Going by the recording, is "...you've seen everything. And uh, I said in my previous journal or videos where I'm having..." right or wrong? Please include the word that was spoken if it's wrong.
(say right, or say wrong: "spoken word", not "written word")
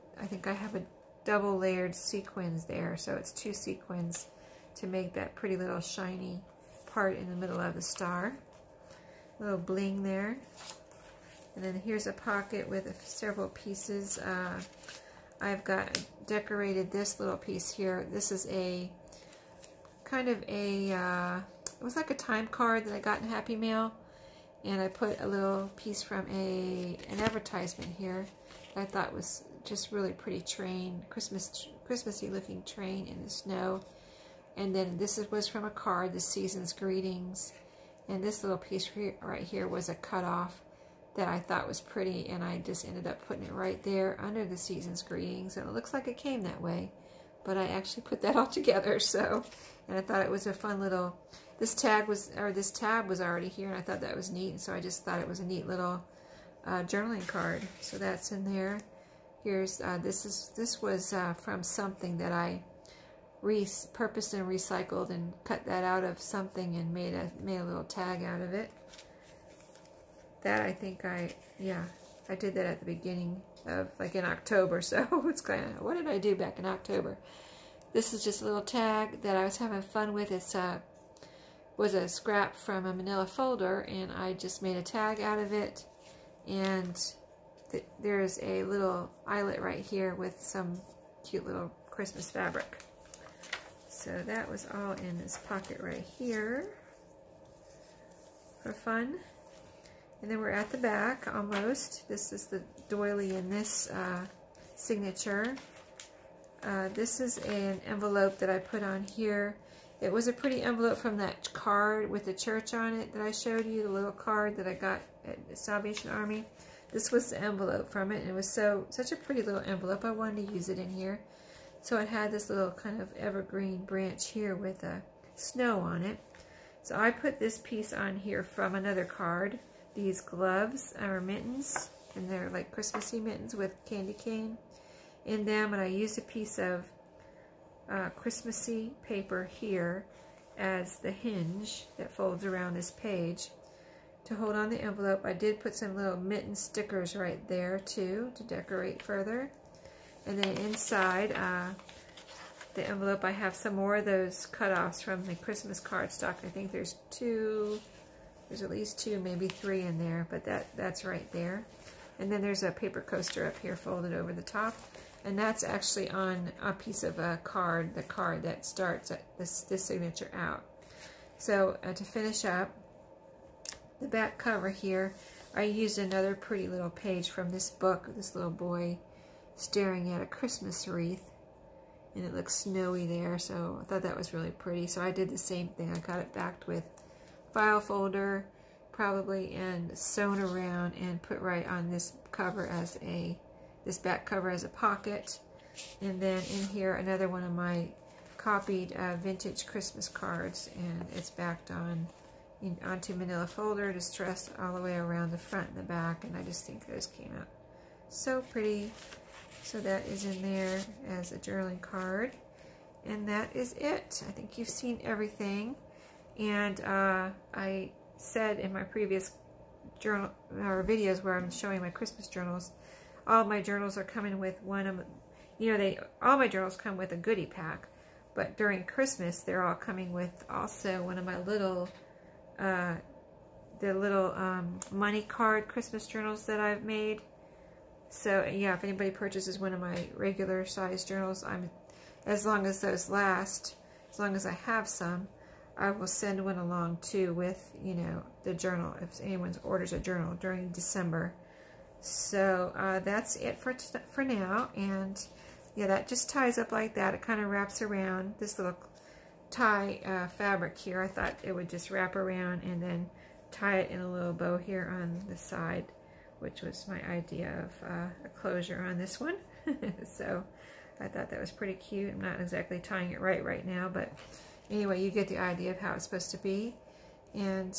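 wrong: "showing", not "having".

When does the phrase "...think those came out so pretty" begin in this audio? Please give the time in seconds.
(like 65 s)
206 s.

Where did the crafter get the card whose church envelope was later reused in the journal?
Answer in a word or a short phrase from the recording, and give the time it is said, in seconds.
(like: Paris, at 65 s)
Salvation Army, at 115 s.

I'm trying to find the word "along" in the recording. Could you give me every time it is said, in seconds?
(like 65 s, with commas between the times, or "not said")
246 s.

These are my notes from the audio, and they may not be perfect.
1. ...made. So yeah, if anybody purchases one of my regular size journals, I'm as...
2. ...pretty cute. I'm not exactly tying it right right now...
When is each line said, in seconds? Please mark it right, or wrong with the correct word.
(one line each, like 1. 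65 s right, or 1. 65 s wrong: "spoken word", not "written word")
1. 236 s right
2. 271 s right.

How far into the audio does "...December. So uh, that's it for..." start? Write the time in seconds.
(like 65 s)
250 s.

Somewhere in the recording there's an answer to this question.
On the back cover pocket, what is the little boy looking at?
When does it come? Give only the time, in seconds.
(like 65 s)
180 s.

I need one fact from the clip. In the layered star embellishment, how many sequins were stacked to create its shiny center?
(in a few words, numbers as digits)
2.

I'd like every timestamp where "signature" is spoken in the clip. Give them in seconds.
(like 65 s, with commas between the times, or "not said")
104 s, 169 s.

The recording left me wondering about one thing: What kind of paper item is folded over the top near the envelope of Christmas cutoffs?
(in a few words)
Paper coaster.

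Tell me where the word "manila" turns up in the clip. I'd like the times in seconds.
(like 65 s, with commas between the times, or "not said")
82 s, 203 s.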